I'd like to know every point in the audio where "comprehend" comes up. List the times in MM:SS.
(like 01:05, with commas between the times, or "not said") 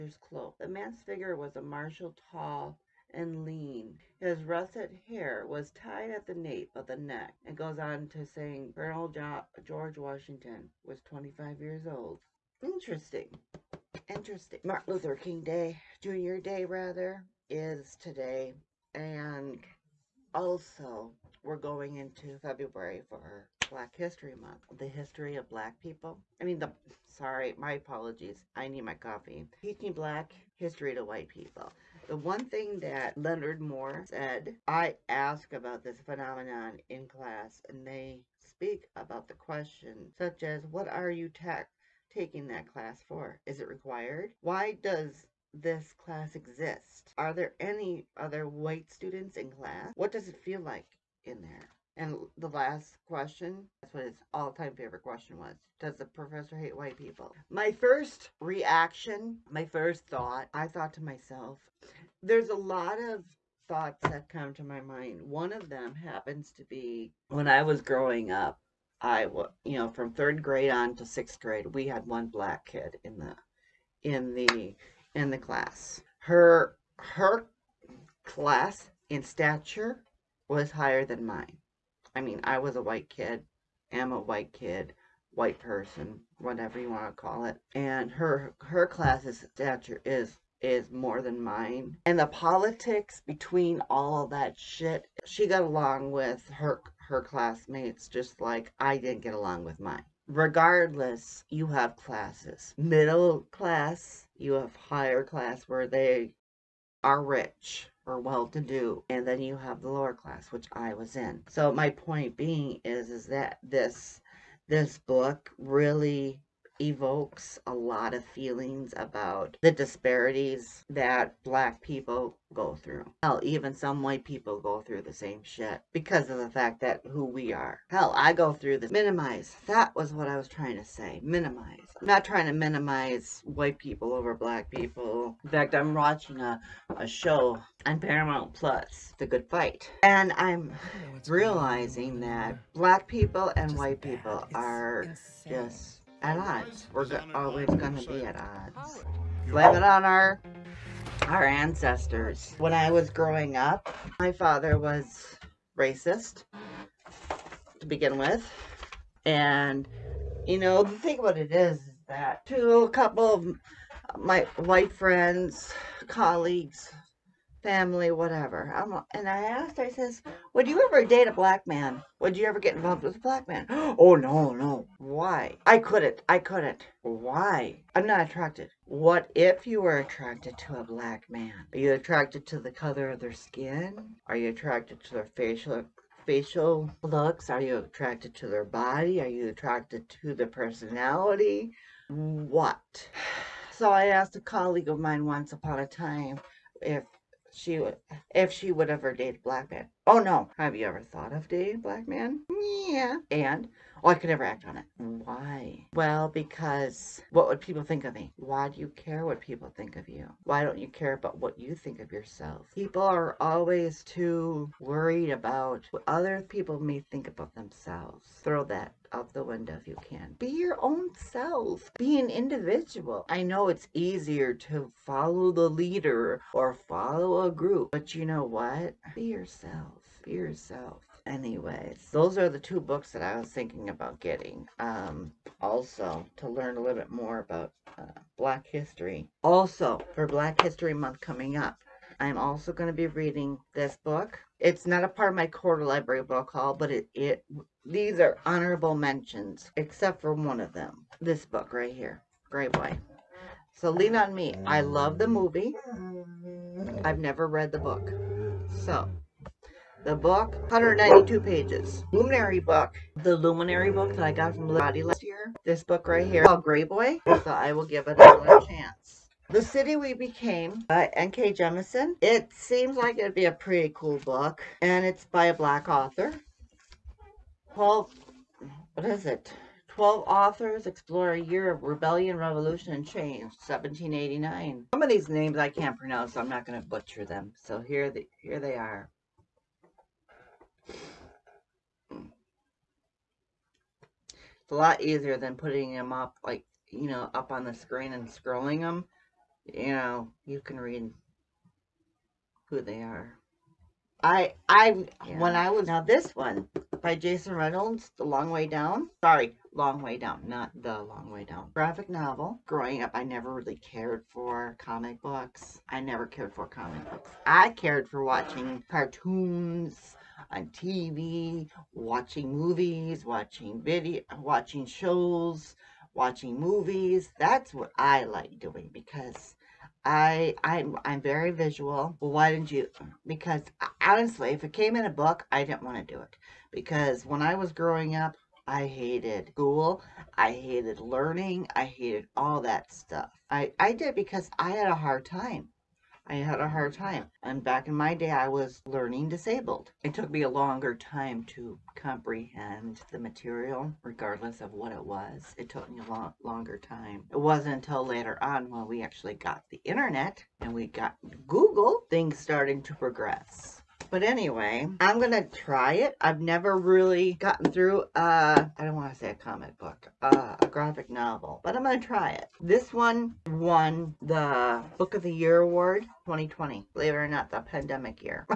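05:51.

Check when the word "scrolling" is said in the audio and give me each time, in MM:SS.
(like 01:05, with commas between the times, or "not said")
04:58.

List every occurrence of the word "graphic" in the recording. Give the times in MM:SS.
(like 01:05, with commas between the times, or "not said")
05:11, 06:10.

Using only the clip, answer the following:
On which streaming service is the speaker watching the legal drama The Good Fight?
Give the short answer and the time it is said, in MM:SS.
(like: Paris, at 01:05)
Paramount Plus, at 02:17.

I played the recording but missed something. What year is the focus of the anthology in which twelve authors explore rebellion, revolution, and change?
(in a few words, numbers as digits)
1789.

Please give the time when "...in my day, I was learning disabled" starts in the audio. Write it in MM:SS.
05:47.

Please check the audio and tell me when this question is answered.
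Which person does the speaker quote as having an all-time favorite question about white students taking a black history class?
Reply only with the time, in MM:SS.
00:33.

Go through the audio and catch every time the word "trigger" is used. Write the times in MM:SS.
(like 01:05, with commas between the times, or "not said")
not said.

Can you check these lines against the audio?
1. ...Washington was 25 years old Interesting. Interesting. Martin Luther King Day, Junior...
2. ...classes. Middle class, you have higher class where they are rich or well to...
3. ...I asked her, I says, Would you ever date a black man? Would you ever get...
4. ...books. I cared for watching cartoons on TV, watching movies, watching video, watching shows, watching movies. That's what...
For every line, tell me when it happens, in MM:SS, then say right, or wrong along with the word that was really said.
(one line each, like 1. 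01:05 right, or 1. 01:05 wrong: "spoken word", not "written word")
1. 00:09 right
2. 01:41 right
3. 02:49 right
4. 05:17 right.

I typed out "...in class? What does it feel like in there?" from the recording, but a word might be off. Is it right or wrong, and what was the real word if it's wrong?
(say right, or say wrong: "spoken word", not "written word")
right.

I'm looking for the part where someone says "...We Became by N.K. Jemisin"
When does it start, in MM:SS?
04:29.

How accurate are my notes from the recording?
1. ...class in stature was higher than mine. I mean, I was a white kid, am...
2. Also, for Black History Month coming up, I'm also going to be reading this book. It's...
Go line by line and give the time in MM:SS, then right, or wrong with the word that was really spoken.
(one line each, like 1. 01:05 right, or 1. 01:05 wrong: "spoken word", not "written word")
1. 01:18 right
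2. 03:59 right.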